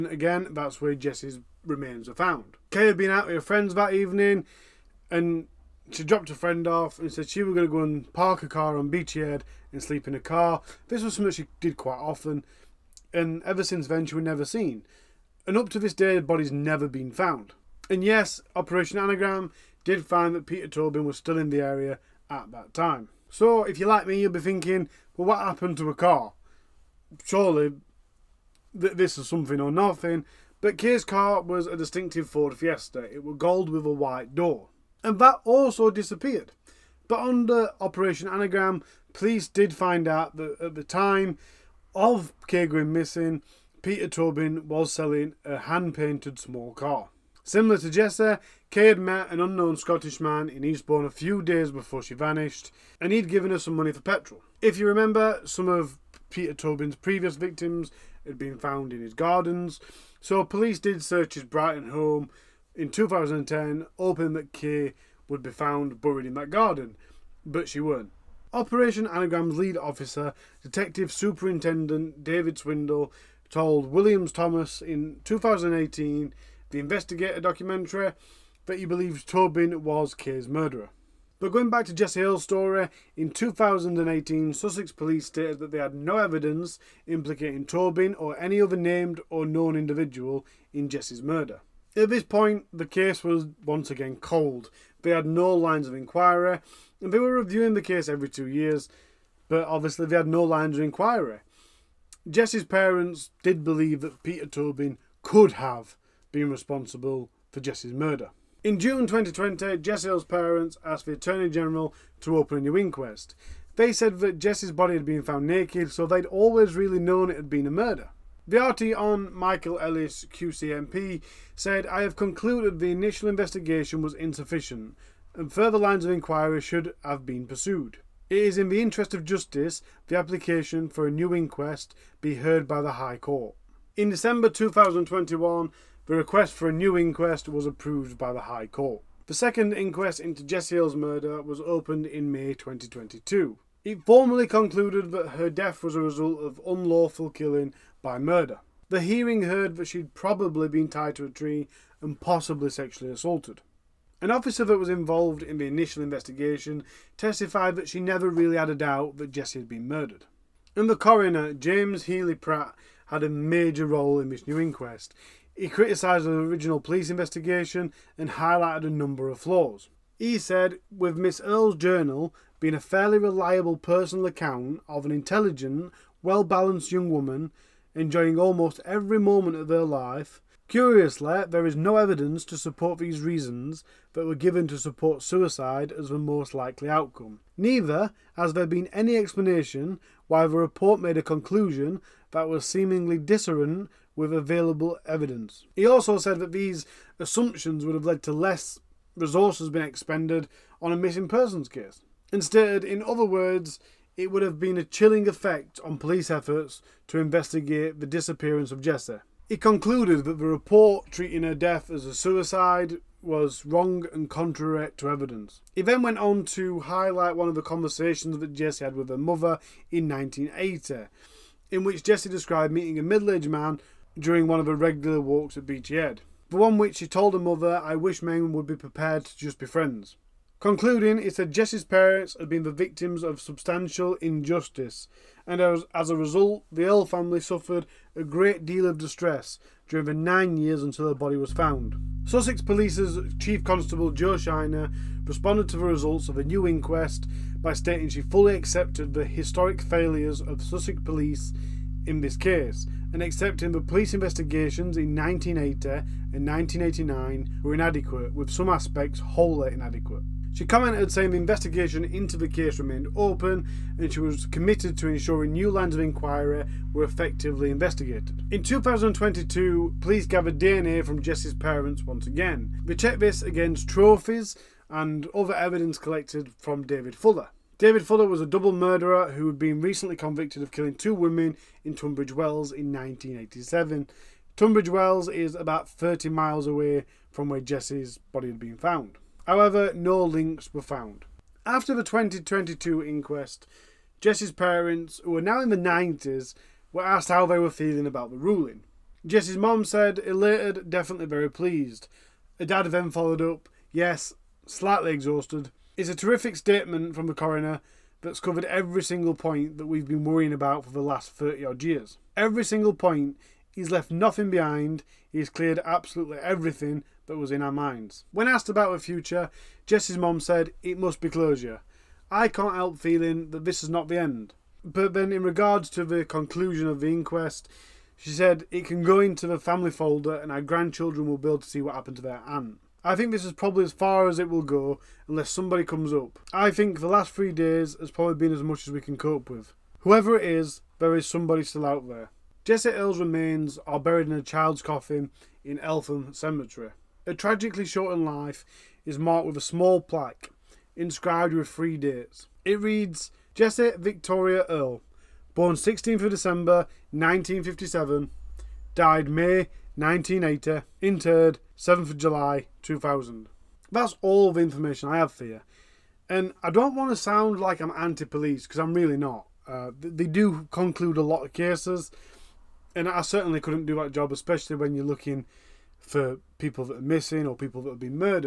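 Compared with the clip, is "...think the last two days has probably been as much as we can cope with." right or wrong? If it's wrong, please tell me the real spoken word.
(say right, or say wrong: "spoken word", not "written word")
wrong: "three", not "two".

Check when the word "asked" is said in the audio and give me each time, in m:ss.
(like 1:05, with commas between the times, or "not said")
1:50, 4:57, 5:18.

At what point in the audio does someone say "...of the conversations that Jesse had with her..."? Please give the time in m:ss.
3:37.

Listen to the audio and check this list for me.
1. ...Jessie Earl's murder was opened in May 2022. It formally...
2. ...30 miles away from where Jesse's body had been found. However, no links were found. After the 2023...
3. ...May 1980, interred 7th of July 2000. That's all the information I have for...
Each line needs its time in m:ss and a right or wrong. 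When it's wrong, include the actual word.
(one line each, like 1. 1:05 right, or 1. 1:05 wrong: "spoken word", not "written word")
1. 2:20 right
2. 4:45 wrong: "2022", not "2023"
3. 5:59 right.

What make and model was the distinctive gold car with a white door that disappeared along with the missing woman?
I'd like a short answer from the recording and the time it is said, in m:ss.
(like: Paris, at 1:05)
Ford Fiesta, at 0:32.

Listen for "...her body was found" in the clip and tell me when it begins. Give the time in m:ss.
4:01.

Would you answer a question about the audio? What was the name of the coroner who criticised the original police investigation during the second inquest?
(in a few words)
James Healy Pratt.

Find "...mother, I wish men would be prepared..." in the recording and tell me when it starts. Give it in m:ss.
3:47.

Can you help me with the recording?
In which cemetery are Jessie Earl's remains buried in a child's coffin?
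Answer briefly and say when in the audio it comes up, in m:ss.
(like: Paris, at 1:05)
Eltham Cemetery, at 5:45.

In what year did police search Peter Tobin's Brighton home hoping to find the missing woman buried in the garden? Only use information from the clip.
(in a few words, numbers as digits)
2010.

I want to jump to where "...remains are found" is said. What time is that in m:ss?
0:01.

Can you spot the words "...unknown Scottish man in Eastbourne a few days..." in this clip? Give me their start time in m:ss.
0:49.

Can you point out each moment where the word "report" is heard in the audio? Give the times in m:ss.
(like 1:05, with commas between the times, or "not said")
3:10, 3:30.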